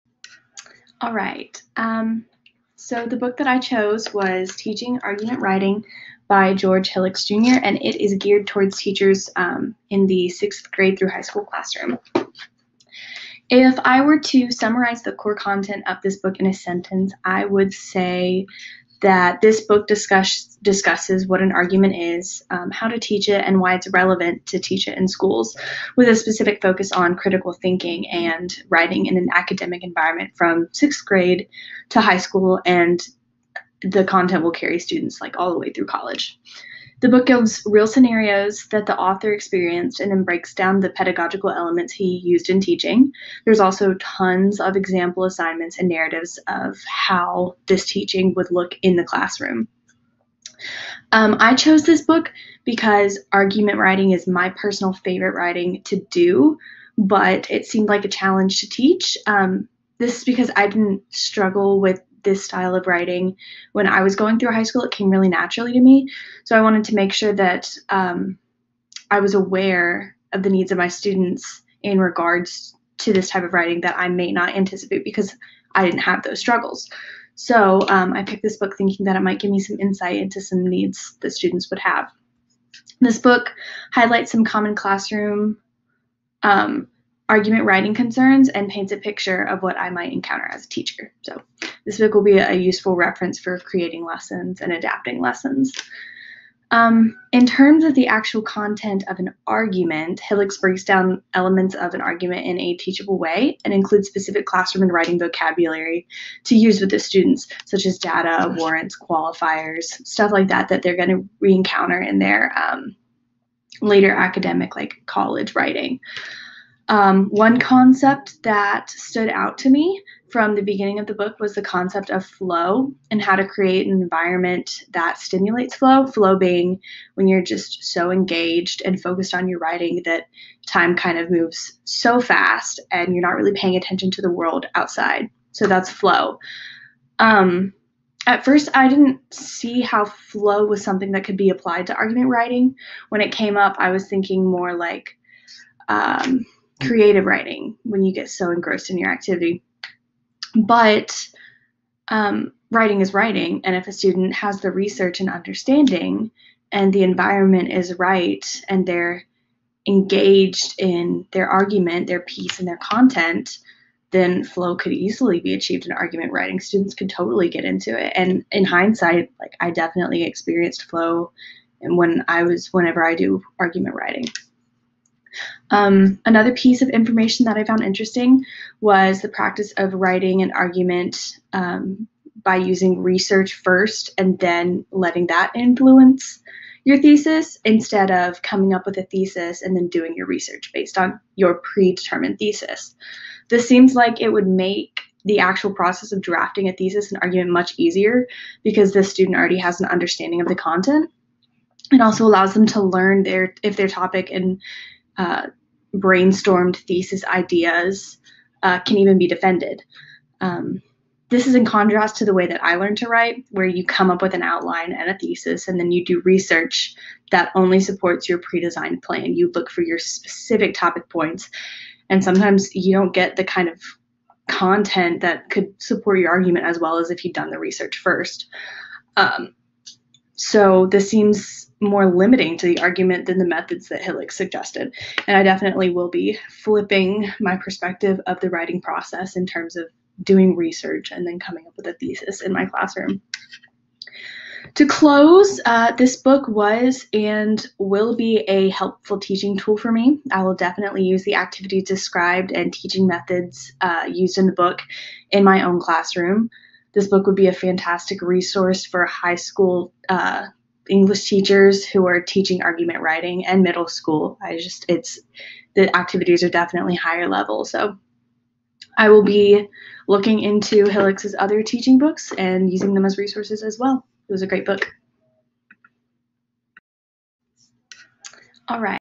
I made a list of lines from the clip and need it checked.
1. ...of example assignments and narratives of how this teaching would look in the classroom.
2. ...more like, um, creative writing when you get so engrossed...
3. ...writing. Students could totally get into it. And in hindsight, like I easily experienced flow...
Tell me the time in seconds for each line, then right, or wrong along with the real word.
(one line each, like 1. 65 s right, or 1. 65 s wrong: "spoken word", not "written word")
1. 44 s right
2. 144 s right
3. 166 s wrong: "definitely", not "easily".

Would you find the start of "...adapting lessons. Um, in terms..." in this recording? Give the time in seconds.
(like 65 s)
94 s.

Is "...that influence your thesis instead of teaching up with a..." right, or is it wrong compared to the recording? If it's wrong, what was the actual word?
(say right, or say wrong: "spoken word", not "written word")
wrong: "coming", not "teaching".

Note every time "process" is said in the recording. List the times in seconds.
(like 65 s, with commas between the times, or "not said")
195 s, 238 s.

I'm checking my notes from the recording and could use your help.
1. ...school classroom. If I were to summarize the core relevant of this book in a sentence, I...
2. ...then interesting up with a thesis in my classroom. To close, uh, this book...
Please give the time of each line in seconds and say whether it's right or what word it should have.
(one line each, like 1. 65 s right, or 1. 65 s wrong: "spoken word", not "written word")
1. 11 s wrong: "content", not "relevant"
2. 241 s wrong: "coming", not "interesting".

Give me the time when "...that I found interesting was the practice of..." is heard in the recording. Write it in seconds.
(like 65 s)
177 s.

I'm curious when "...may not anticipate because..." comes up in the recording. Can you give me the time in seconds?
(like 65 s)
74 s.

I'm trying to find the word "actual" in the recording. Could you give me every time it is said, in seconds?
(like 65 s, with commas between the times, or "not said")
98 s, 195 s.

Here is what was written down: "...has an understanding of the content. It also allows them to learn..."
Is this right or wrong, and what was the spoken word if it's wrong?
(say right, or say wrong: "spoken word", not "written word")
right.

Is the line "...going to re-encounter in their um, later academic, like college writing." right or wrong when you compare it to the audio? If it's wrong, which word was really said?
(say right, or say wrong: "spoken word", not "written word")
right.